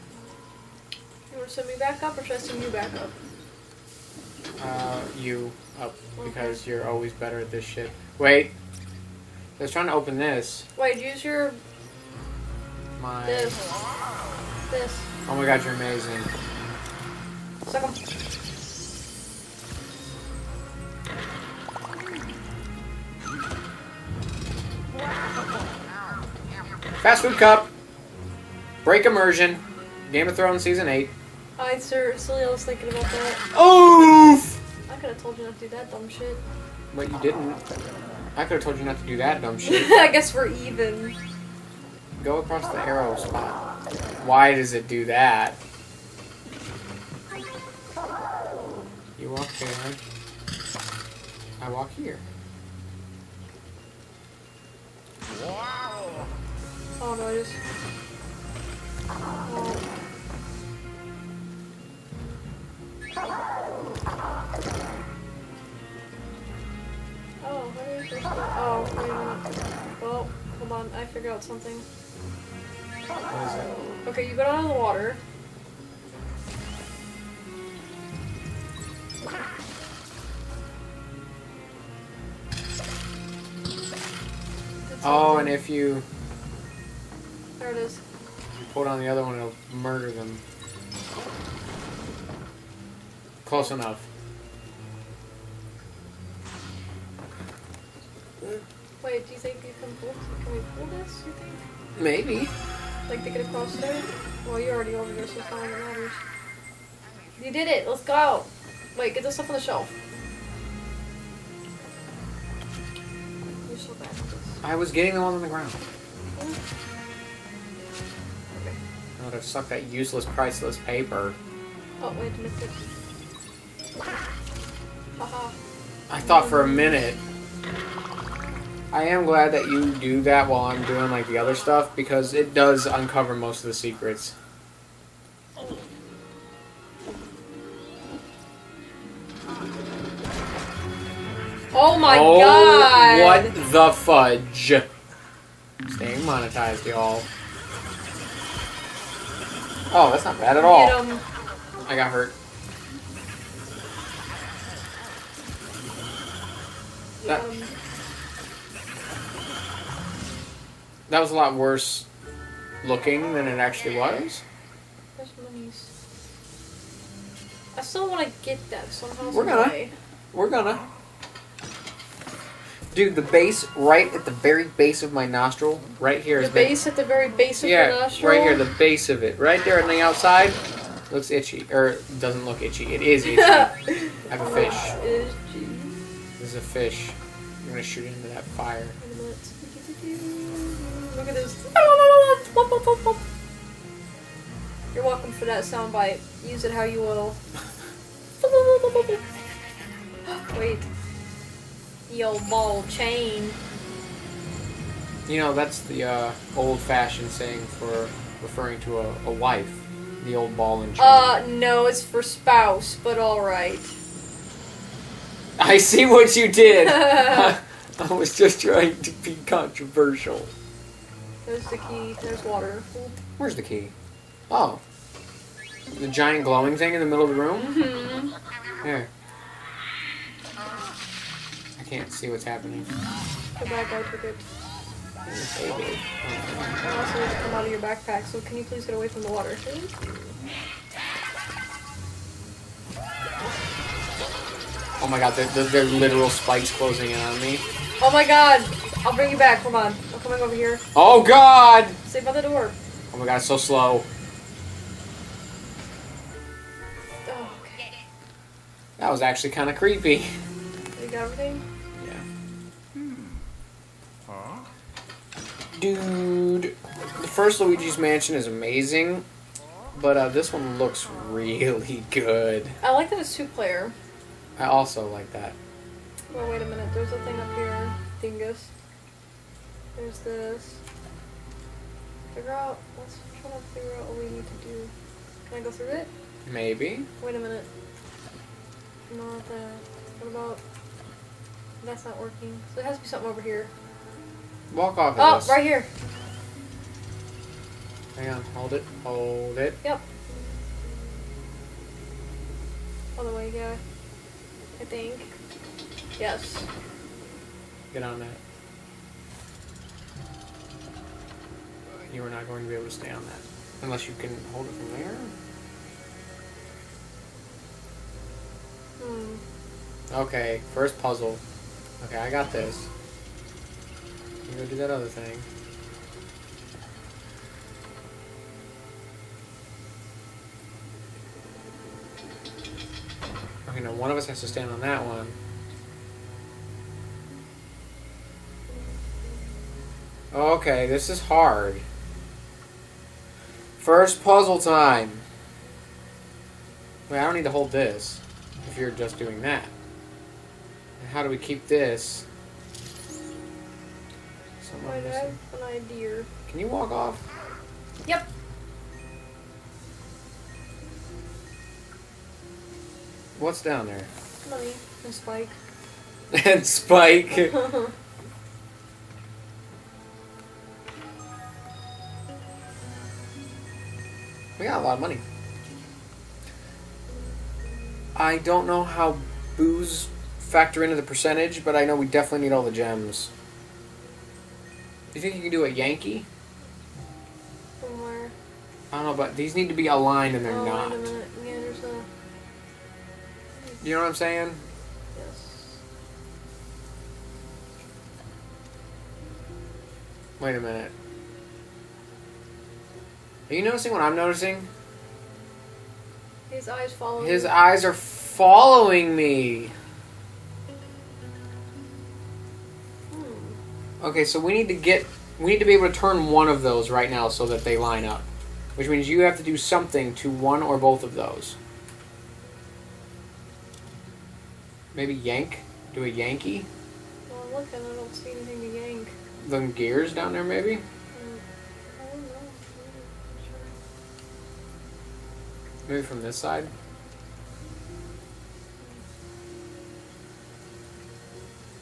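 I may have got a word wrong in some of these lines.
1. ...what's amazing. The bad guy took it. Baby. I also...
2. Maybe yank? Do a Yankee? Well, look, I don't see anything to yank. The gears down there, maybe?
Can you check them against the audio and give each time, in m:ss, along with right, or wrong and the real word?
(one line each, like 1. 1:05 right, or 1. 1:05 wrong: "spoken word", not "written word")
1. 3:52 wrong: "happening", not "amazing"
2. 7:04 right.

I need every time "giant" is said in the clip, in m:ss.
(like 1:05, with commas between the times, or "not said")
3:46.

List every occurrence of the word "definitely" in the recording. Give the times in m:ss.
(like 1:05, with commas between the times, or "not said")
6:22.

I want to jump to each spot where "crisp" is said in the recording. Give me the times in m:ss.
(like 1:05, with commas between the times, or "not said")
not said.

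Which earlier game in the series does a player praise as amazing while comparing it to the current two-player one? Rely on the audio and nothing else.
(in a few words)
The first Luigi's Mansion.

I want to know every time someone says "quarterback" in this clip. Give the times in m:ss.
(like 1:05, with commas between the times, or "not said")
not said.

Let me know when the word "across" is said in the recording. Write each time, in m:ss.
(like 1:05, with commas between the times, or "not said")
0:42, 1:43.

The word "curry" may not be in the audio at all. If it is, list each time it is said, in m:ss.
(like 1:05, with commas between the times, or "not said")
not said.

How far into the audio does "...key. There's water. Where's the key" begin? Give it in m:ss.
3:41.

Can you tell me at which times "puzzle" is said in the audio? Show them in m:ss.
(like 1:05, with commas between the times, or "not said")
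5:21, 5:44.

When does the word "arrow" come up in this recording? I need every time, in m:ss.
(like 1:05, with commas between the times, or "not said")
0:42.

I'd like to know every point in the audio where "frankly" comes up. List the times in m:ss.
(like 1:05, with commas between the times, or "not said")
not said.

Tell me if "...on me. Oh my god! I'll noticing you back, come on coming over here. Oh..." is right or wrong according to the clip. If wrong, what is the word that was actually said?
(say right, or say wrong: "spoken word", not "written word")
wrong: "bring", not "noticing".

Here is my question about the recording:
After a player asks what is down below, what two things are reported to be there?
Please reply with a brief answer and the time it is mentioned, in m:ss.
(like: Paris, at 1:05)
Money and Spike, at 6:04.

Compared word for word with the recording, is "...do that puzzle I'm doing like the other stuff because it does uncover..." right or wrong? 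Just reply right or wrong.
wrong.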